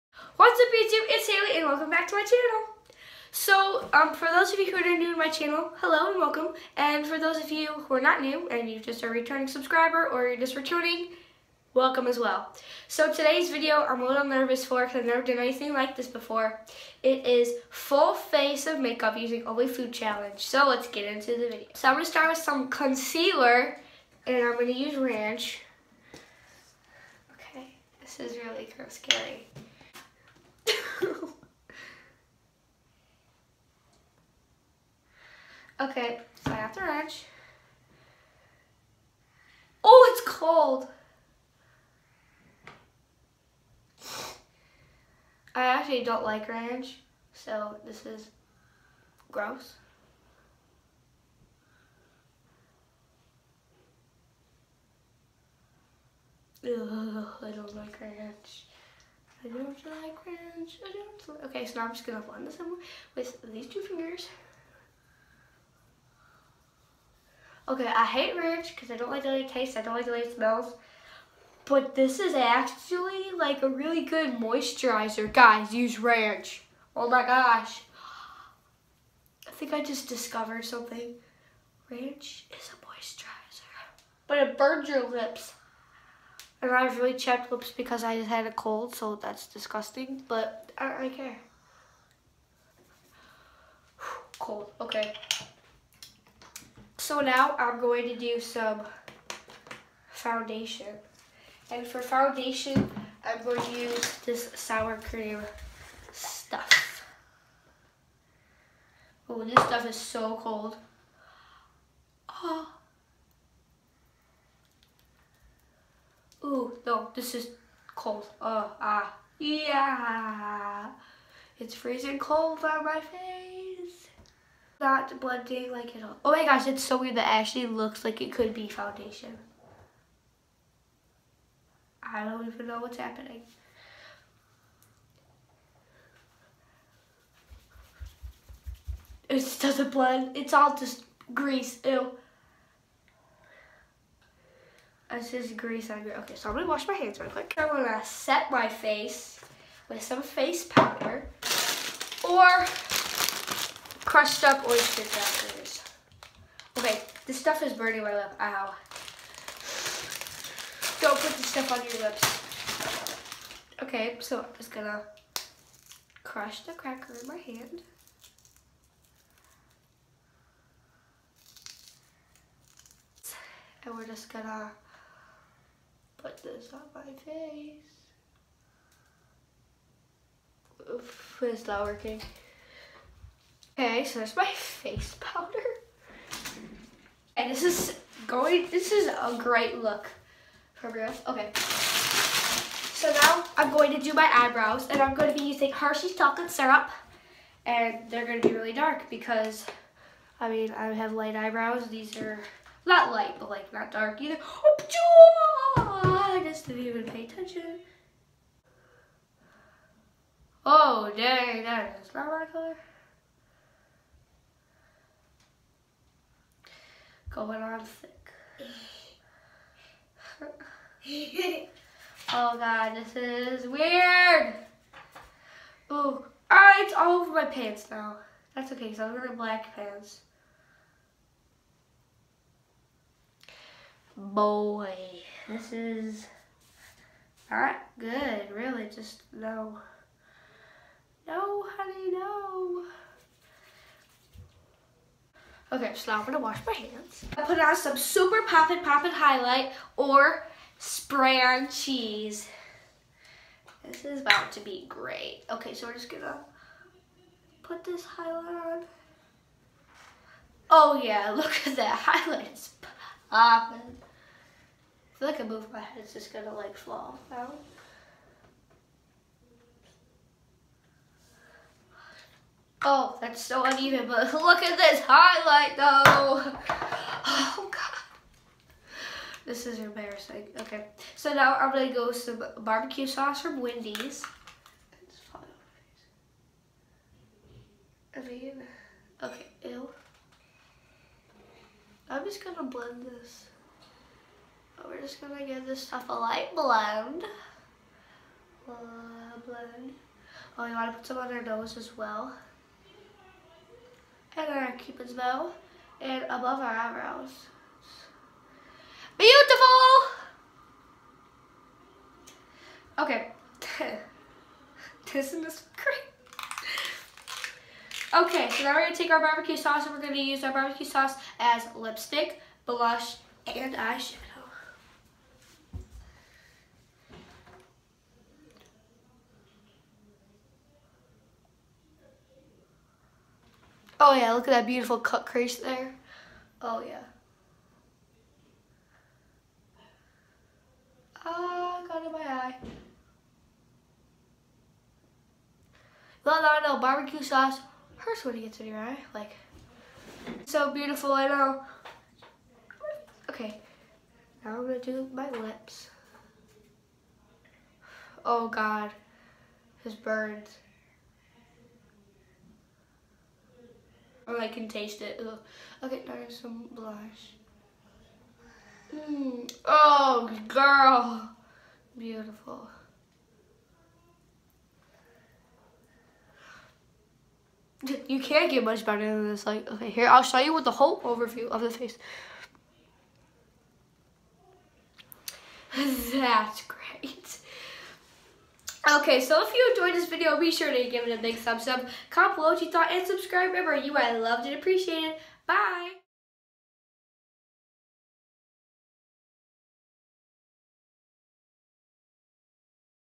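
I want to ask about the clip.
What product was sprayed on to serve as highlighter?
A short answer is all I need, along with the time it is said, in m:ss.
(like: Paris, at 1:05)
Spray on cheese, at 4:10.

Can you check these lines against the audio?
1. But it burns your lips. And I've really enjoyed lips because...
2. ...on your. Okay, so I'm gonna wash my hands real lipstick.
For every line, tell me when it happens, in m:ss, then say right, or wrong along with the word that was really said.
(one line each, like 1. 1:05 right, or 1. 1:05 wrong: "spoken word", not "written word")
1. 1:24 wrong: "chapped", not "enjoyed"
2. 2:25 wrong: "quick", not "lipstick".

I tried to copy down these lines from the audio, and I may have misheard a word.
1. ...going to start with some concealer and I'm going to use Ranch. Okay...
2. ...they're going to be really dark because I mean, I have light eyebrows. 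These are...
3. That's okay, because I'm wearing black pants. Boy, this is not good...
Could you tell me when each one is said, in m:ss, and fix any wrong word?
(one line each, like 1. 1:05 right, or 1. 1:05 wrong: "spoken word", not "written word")
1. 0:21 right
2. 3:18 right
3. 3:48 right.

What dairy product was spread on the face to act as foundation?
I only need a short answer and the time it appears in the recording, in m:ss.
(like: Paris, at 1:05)
Sour cream, at 1:44.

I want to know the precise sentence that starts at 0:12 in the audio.
So today's video I'm a little nervous for because I've never done anything like this before.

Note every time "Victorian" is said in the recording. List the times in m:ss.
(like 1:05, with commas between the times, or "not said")
not said.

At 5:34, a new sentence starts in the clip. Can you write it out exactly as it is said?
Oh yeah, look at that beautiful cut crease there.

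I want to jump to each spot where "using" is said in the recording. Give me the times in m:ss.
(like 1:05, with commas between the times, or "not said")
0:19, 3:15.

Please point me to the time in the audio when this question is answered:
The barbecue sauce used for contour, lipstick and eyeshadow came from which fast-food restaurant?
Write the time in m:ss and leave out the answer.
4:43.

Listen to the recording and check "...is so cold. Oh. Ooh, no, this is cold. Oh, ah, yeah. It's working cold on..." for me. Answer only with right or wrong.
wrong.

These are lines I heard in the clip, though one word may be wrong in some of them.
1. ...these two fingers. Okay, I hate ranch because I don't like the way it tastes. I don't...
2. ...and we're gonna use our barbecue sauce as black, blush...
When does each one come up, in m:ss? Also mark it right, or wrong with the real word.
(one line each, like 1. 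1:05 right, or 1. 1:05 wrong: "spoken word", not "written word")
1. 1:03 right
2. 5:19 wrong: "lipstick", not "black".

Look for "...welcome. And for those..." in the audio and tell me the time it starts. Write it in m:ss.
0:06.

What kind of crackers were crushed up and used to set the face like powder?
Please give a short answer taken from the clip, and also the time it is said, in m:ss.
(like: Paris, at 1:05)
Oyster crackers, at 2:34.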